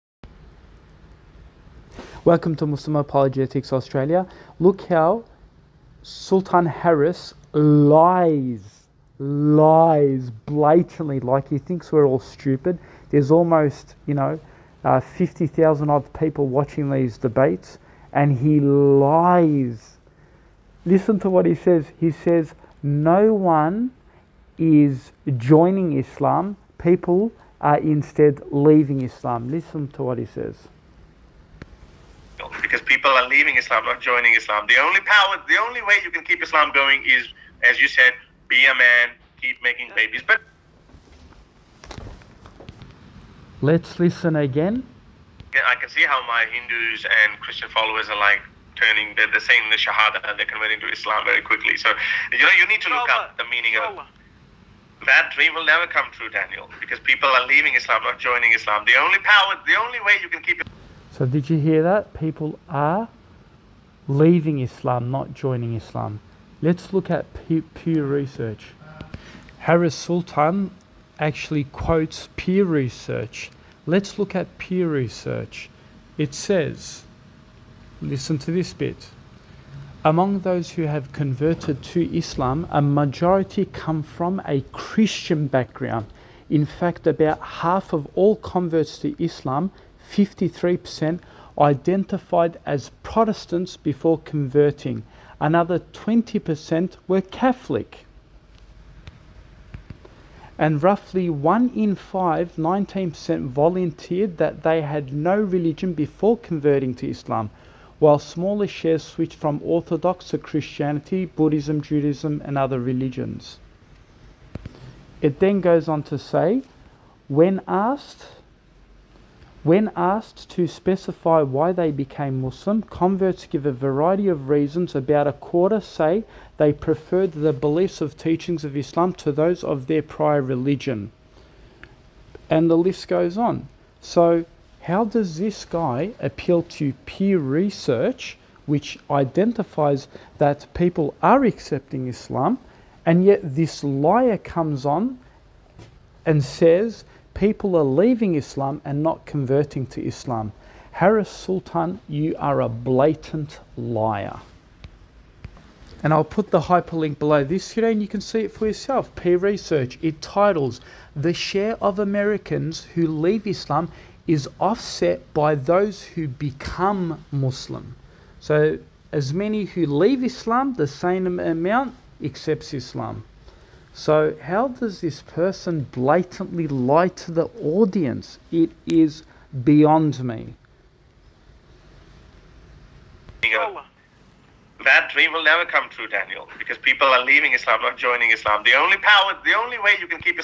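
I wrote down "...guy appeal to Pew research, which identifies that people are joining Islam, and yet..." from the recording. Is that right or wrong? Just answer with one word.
wrong.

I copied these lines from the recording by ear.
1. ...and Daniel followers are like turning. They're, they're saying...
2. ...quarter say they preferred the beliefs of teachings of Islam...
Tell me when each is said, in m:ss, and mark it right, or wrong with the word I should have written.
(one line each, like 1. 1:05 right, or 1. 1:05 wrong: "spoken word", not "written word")
1. 0:47 wrong: "Christian", not "Daniel"
2. 2:05 right.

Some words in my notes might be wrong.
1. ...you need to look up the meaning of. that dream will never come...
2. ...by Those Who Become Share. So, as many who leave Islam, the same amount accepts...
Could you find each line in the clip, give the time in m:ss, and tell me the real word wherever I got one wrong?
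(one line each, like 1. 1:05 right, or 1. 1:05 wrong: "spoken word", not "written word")
1. 0:52 right
2. 2:45 wrong: "Muslim", not "Share".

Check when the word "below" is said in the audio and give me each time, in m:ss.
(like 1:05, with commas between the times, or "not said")
2:37.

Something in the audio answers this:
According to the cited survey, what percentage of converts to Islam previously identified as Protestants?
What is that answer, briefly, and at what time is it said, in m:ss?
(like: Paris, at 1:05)
53%, at 1:30.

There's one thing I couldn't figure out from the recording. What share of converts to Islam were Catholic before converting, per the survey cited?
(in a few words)
20%.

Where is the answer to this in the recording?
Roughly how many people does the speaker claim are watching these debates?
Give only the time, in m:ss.
0:14.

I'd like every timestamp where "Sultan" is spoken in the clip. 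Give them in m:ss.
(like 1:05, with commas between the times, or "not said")
0:06, 1:09, 2:31.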